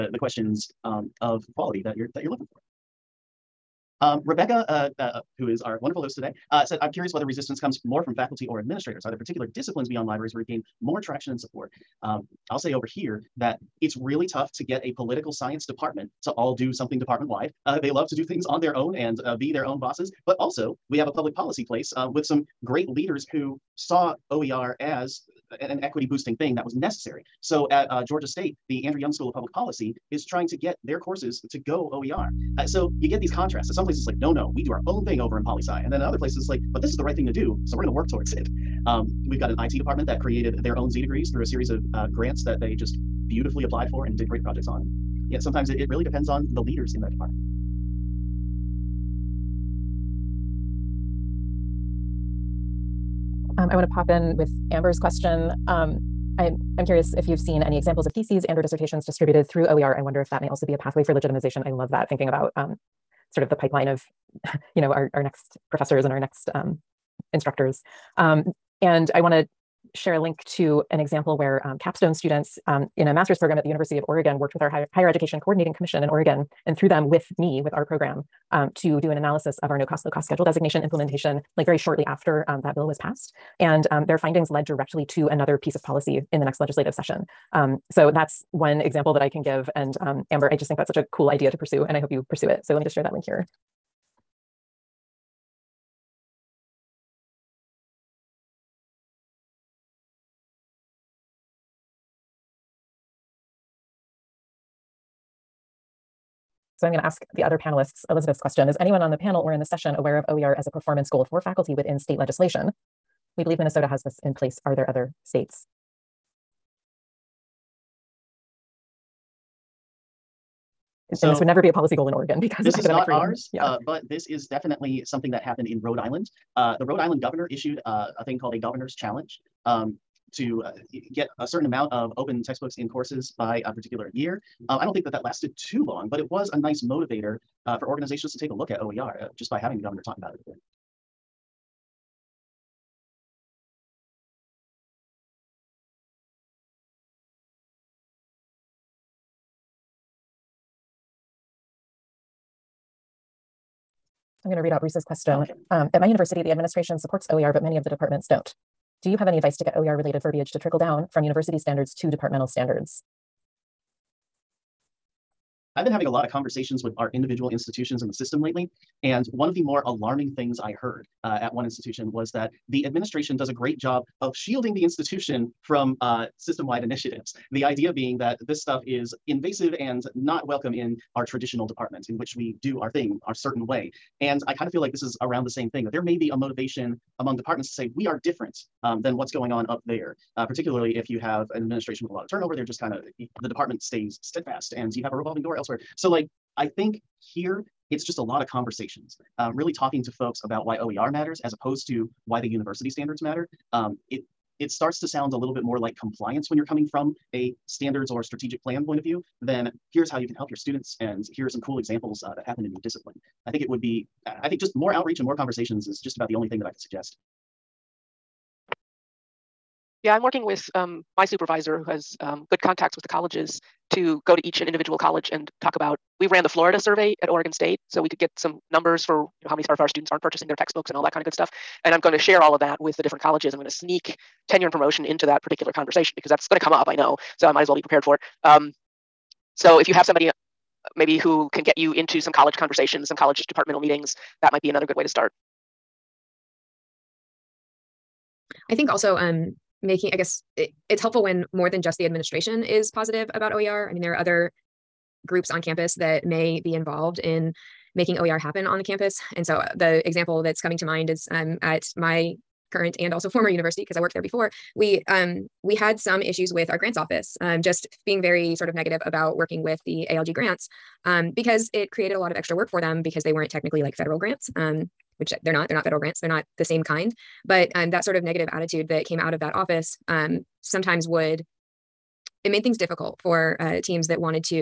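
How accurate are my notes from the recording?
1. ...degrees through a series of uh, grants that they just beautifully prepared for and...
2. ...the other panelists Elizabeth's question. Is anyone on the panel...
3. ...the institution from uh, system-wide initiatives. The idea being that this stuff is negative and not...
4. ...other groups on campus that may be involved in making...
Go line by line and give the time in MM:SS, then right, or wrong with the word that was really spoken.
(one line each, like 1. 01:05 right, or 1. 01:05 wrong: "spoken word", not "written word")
1. 00:41 wrong: "applied", not "prepared"
2. 01:47 right
3. 02:54 wrong: "invasive", not "negative"
4. 04:14 right.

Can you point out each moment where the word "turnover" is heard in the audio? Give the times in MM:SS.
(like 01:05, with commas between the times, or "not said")
03:12.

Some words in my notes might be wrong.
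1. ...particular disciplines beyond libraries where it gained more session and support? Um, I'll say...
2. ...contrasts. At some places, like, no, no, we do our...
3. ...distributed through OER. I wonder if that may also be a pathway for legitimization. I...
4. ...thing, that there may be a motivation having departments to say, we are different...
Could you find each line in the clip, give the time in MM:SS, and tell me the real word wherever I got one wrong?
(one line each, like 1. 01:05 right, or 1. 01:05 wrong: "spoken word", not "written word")
1. 00:09 wrong: "traction", not "session"
2. 00:33 right
3. 00:59 right
4. 03:05 wrong: "among", not "having".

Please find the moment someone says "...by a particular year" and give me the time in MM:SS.
02:13.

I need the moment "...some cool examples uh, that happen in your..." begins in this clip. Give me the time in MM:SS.
03:31.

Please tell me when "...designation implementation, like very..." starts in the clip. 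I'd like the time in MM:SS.
01:20.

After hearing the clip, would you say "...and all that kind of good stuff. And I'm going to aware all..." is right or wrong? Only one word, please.
wrong.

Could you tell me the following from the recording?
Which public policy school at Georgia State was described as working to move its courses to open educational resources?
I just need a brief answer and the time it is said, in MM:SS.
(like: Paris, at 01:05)
Andrew Young School of Public Policy, at 00:28.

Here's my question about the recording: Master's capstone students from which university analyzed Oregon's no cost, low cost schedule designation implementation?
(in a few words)
University of Oregon.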